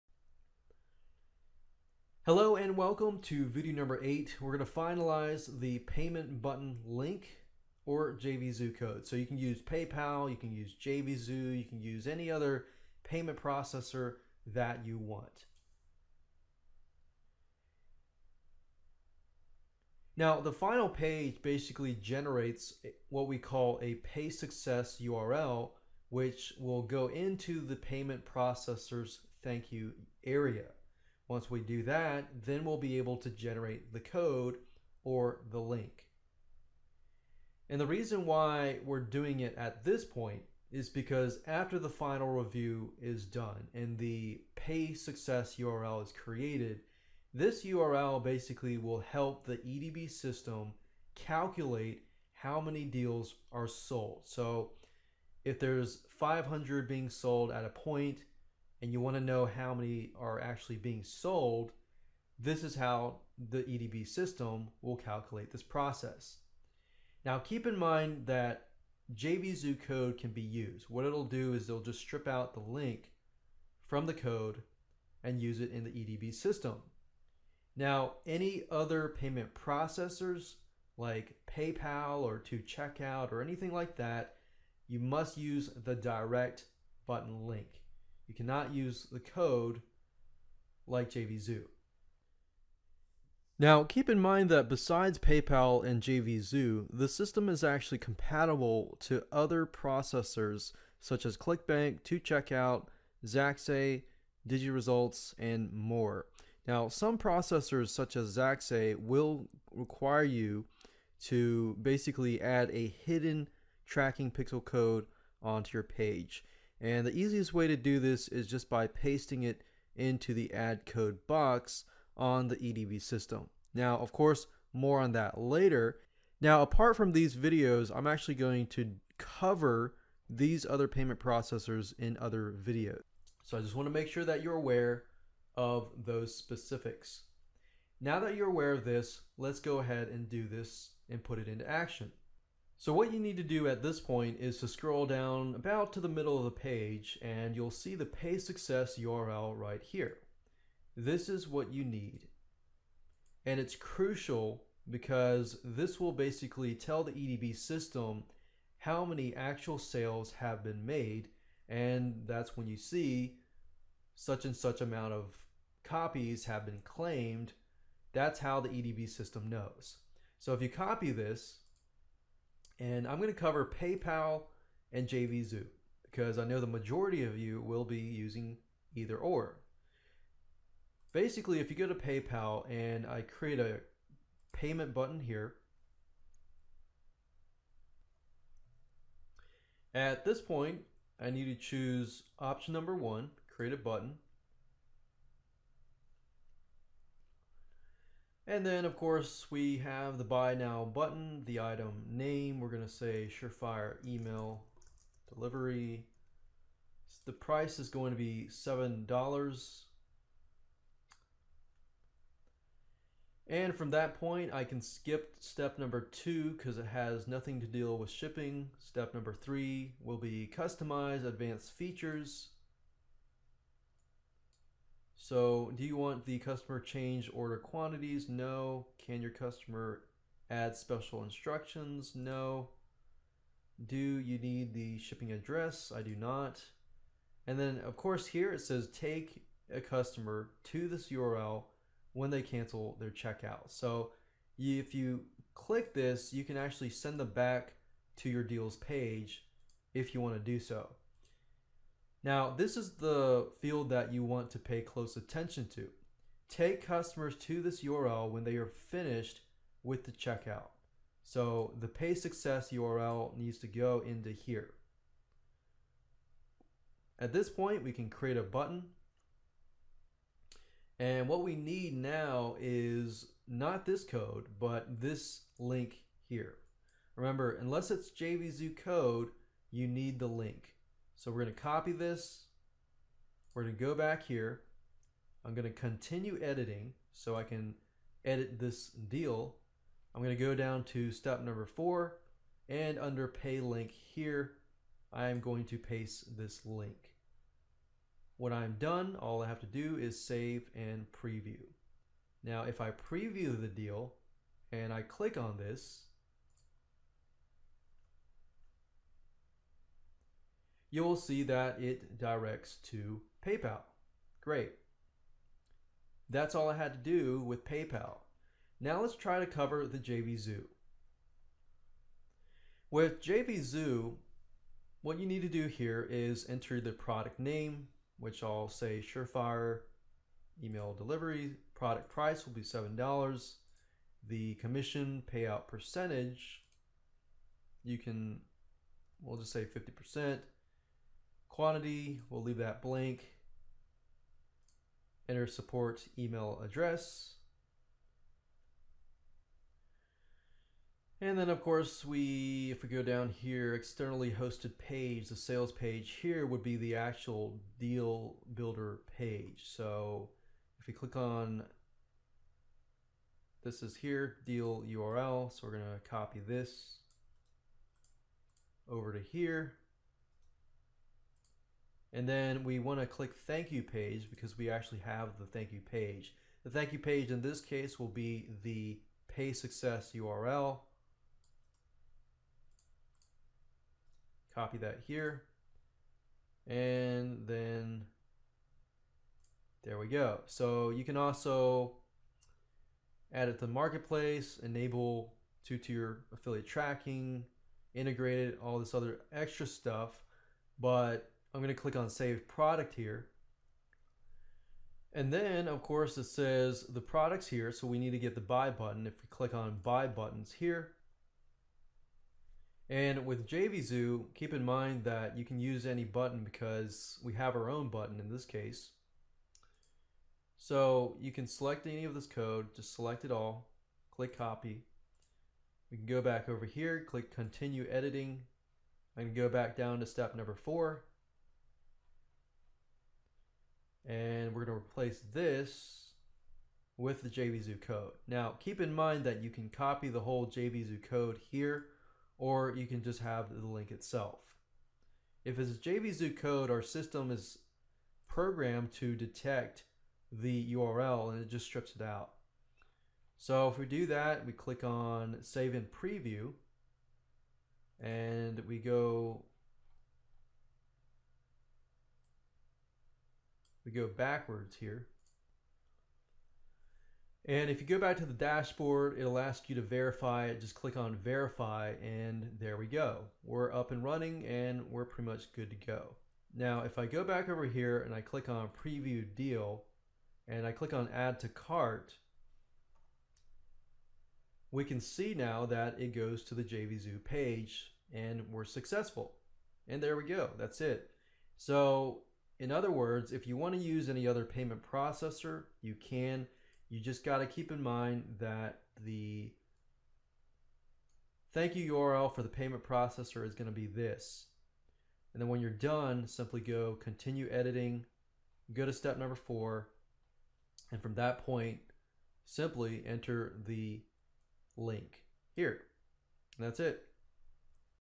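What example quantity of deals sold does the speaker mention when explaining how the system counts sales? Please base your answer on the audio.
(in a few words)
500.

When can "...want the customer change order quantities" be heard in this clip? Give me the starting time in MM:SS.
03:45.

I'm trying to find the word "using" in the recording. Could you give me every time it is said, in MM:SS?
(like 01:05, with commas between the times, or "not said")
02:57.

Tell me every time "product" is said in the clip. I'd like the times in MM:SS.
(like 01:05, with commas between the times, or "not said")
05:26, 05:31, 06:42, 06:47.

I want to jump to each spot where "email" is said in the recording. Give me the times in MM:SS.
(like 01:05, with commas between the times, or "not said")
03:24, 05:30, 05:46.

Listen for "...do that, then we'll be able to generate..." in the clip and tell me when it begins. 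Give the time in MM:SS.
00:31.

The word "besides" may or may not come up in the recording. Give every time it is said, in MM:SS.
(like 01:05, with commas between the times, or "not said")
01:34.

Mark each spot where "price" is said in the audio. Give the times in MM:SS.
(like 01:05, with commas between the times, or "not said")
03:27, 05:32.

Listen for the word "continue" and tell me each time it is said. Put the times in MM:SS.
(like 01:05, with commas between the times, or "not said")
04:45, 07:07, 08:27.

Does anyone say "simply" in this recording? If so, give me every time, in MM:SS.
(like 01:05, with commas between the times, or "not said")
08:26, 08:32.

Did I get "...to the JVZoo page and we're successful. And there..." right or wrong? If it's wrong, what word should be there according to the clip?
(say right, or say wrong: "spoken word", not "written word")
right.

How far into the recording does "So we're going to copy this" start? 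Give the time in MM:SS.
04:41.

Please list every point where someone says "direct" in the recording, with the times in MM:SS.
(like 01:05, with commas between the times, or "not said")
01:25, 05:12.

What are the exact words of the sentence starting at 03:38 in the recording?
Step number three will be customize advanced features.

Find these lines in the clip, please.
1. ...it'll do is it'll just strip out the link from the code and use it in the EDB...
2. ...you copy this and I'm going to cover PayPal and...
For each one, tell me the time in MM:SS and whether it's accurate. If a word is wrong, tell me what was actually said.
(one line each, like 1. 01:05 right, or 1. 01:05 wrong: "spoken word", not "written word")
1. 01:11 right
2. 02:50 right.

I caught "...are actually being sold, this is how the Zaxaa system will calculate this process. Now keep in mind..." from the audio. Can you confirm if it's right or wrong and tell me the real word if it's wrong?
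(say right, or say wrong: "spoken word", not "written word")
wrong: "EDB", not "Zaxaa".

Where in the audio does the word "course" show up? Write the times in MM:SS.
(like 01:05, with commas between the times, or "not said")
02:04, 03:18, 03:57, 05:51, 06:45.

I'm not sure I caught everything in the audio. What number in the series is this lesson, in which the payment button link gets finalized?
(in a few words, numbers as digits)
8.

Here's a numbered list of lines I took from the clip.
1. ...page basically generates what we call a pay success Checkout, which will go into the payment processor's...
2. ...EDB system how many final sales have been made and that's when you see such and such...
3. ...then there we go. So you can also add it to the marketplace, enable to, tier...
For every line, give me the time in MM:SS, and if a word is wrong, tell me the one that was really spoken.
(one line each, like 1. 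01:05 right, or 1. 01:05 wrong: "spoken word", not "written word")
1. 00:20 wrong: "URL", not "Checkout"
2. 02:37 wrong: "actual", not "final"
3. 06:27 right.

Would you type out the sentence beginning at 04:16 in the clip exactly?
Take customers to this URL when they are finished with the checkout.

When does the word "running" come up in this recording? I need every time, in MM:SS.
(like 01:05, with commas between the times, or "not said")
07:54.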